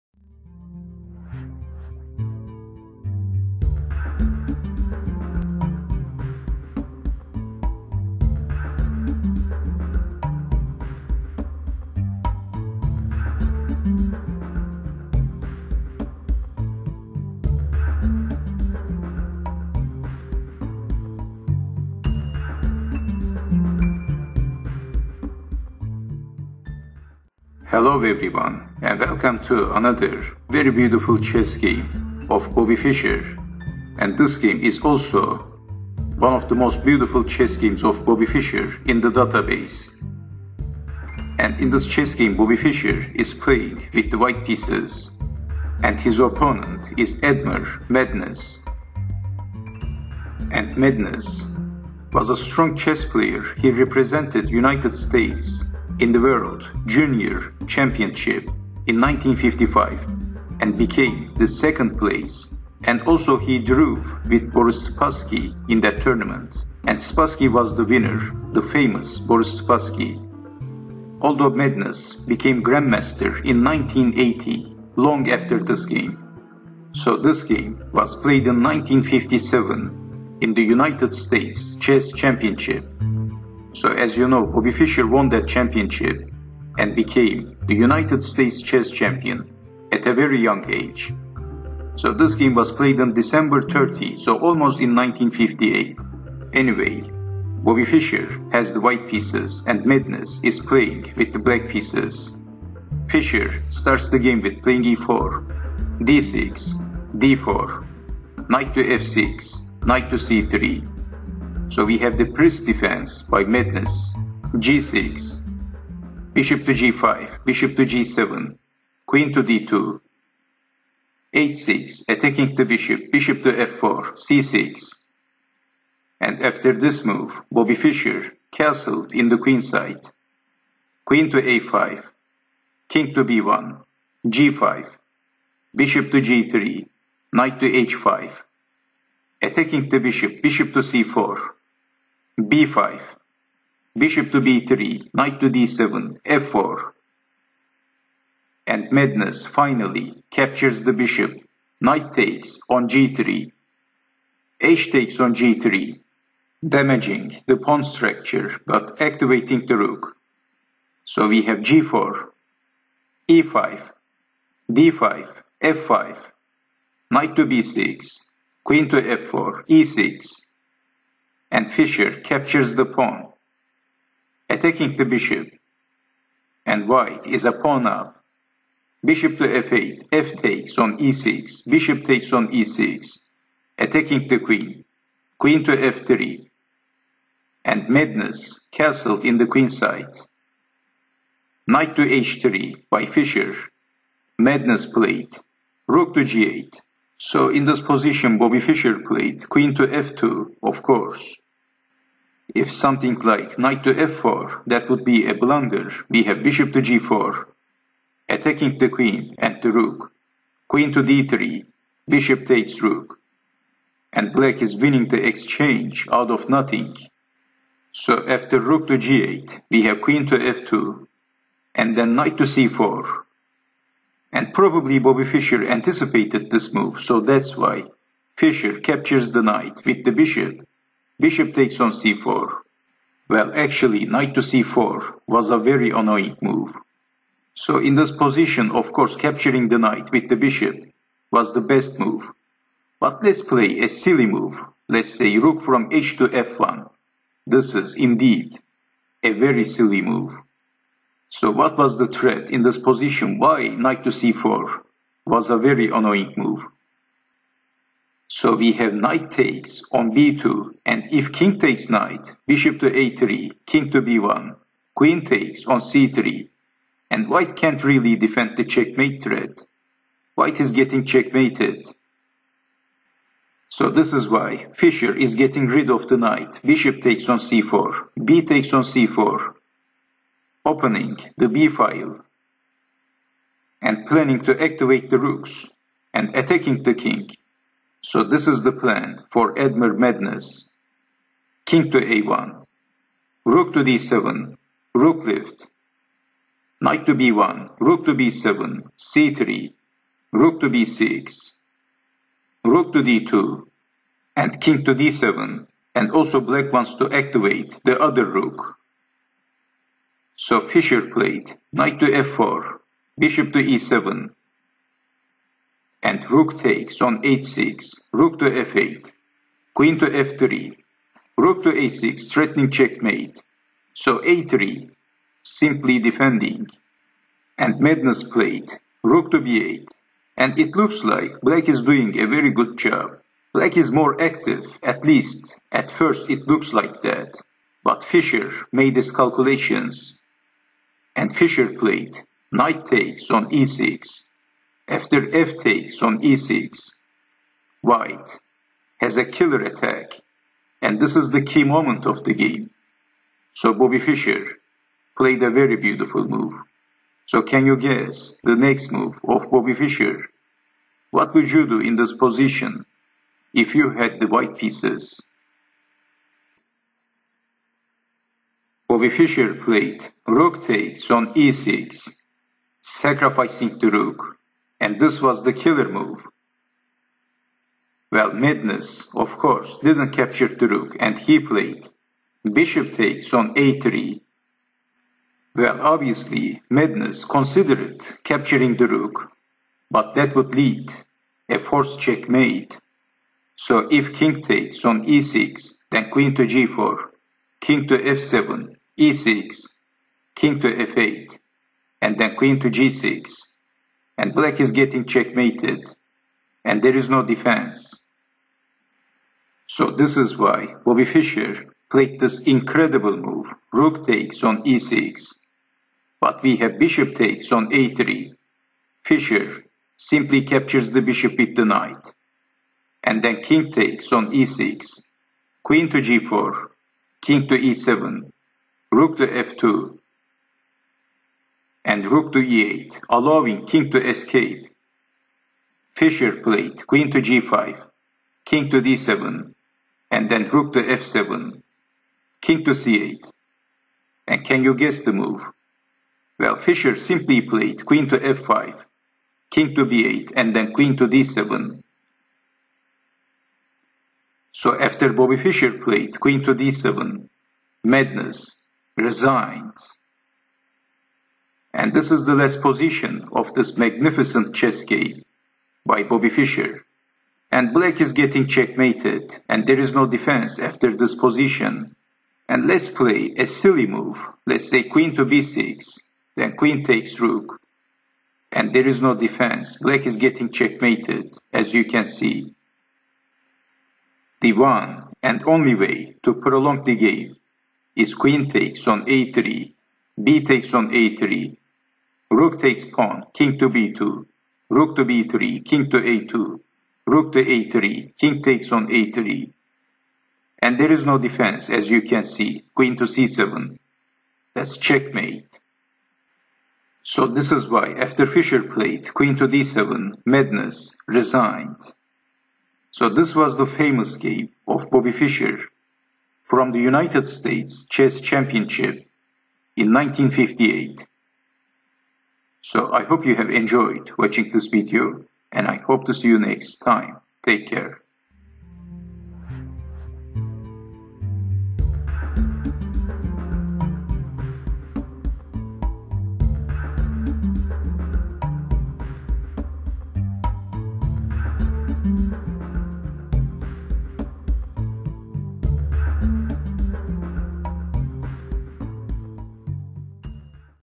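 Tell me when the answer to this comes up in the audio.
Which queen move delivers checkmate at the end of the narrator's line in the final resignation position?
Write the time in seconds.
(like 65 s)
502 s.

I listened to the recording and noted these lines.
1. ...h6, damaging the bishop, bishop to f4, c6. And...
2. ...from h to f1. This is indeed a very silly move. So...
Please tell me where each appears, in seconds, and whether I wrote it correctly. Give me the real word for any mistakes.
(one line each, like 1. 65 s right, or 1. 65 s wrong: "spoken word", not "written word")
1. 121 s wrong: "attacking", not "damaging"
2. 245 s right.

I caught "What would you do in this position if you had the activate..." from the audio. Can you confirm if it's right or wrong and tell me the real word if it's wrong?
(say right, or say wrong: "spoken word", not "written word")
wrong: "white", not "activate".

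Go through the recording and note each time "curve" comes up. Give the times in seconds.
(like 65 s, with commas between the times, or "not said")
not said.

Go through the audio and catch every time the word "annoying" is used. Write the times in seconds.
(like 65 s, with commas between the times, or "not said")
235 s, 255 s.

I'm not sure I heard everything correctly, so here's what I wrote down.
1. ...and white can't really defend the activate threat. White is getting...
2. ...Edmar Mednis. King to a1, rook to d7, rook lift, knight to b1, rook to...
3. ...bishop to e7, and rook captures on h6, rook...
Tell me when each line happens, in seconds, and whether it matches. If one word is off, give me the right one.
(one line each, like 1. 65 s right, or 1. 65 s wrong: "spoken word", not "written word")
1. 267 s wrong: "checkmate", not "activate"
2. 289 s right
3. 313 s wrong: "takes", not "captures".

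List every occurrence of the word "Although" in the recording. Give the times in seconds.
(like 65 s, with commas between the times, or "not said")
71 s.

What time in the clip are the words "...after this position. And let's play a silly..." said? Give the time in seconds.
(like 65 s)
470 s.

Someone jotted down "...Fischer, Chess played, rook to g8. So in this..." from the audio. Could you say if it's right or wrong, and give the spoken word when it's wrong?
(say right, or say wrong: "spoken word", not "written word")
wrong: "Mednis", not "Chess".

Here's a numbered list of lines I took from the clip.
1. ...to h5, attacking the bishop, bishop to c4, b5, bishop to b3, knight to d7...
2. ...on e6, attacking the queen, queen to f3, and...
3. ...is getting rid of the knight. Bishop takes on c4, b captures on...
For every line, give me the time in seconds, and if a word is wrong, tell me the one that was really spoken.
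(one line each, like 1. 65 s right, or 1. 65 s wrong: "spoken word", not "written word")
1. 137 s right
2. 182 s right
3. 275 s wrong: "takes", not "captures".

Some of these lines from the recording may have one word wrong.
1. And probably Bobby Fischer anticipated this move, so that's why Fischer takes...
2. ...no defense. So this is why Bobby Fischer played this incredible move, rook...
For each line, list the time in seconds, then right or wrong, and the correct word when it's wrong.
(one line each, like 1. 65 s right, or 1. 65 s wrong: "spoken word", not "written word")
1. 224 s wrong: "captures", not "takes"
2. 407 s right.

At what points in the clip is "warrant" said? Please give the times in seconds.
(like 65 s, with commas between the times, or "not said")
not said.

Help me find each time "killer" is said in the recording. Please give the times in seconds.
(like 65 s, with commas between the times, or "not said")
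349 s, 375 s.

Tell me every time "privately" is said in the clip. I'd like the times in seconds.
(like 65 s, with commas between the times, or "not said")
not said.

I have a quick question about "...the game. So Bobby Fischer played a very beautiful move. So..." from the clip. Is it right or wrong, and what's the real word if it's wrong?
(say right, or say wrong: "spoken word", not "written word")
right.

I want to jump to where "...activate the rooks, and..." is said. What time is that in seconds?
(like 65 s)
284 s.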